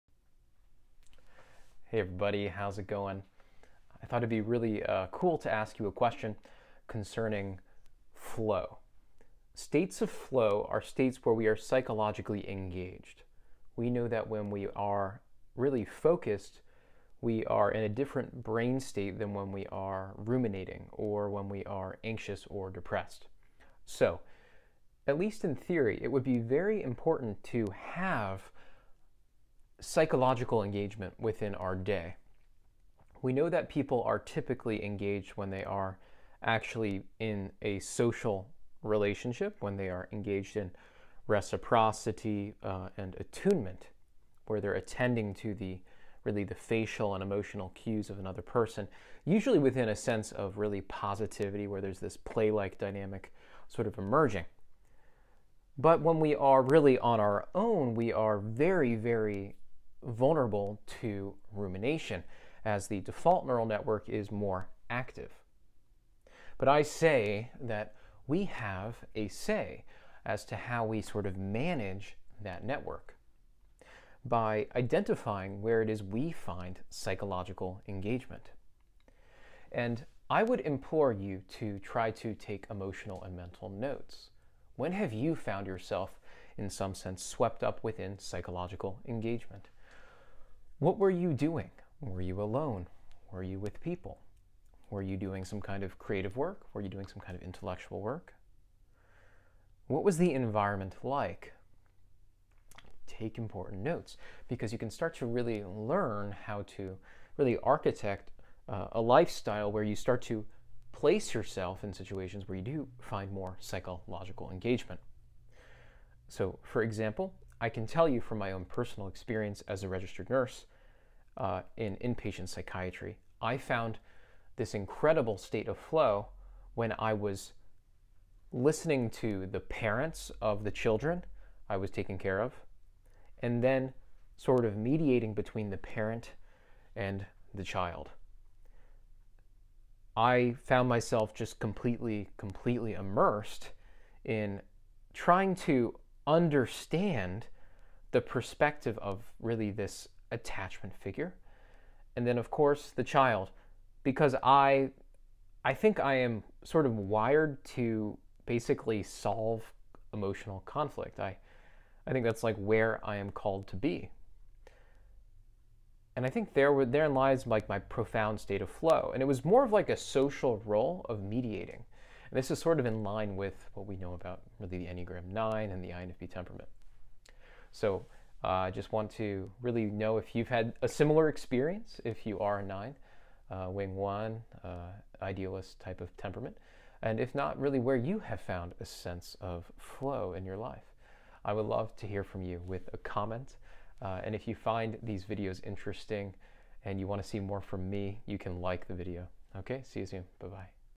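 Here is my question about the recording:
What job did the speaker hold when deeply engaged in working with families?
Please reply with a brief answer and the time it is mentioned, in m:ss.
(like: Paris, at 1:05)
registered nurse, at 1:59.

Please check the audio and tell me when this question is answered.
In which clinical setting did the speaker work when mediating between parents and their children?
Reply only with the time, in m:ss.
2:01.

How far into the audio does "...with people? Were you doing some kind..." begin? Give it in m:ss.
1:33.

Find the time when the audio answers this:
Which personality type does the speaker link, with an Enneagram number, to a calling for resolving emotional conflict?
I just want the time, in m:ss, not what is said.
2:55.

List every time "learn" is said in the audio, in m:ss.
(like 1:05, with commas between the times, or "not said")
1:45.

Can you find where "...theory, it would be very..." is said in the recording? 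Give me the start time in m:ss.
0:25.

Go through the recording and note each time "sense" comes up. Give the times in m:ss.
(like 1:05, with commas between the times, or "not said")
0:49, 1:26, 3:08.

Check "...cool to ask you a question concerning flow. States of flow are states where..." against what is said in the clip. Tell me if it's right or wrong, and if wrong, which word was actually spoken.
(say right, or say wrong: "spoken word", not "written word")
right.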